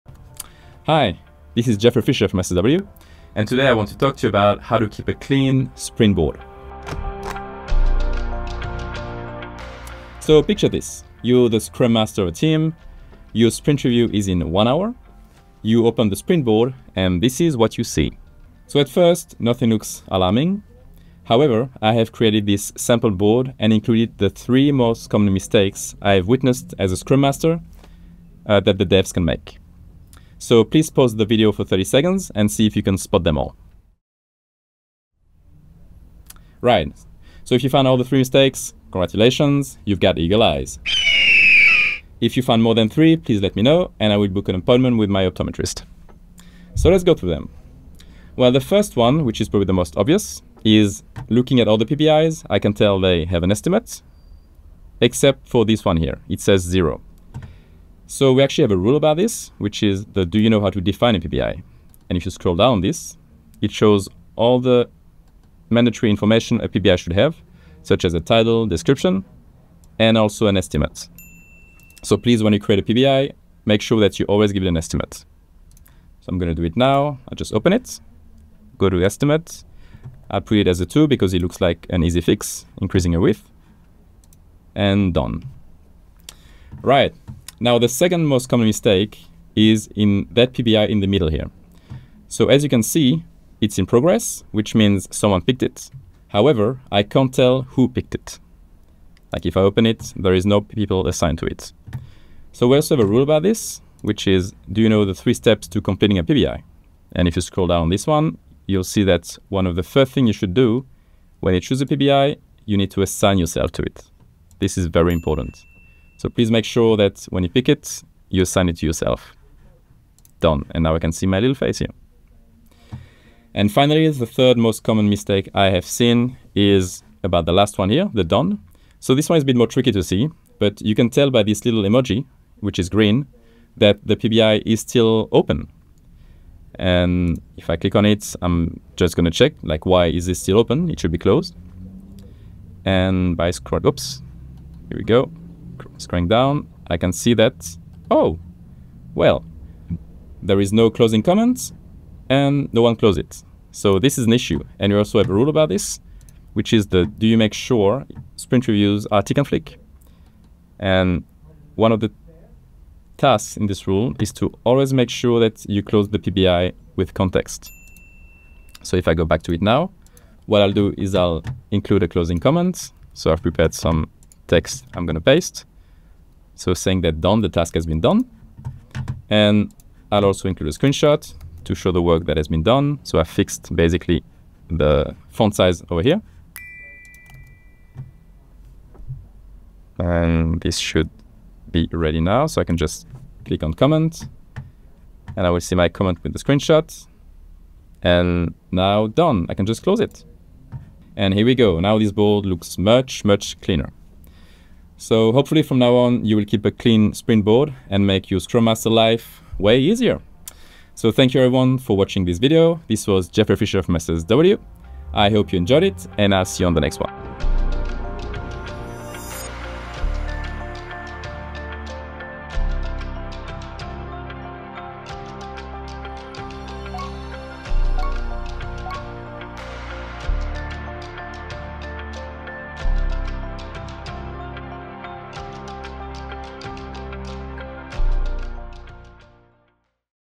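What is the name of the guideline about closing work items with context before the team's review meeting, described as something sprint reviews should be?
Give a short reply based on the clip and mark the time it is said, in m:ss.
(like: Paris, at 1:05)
Tick and flick, at 2:39.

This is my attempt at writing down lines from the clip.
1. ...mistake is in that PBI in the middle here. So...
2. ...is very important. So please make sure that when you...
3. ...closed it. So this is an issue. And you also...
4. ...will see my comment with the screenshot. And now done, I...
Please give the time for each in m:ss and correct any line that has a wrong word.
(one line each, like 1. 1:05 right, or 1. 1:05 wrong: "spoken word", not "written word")
1. 1:28 right
2. 1:54 right
3. 2:32 right
4. 3:15 right.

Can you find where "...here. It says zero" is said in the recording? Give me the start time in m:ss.
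0:55.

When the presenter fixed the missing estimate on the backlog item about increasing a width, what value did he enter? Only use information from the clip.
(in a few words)
2.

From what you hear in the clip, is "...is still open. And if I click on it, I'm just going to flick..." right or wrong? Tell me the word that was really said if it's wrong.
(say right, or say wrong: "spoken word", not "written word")
wrong: "check", not "flick".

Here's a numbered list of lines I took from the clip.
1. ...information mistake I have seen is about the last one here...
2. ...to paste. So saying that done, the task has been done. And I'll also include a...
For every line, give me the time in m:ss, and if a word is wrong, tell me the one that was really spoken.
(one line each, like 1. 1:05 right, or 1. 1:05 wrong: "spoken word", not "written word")
1. 2:04 wrong: "common", not "information"
2. 2:55 right.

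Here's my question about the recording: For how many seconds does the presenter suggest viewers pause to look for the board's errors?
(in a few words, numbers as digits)
30.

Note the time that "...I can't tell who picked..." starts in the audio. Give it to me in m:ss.
1:36.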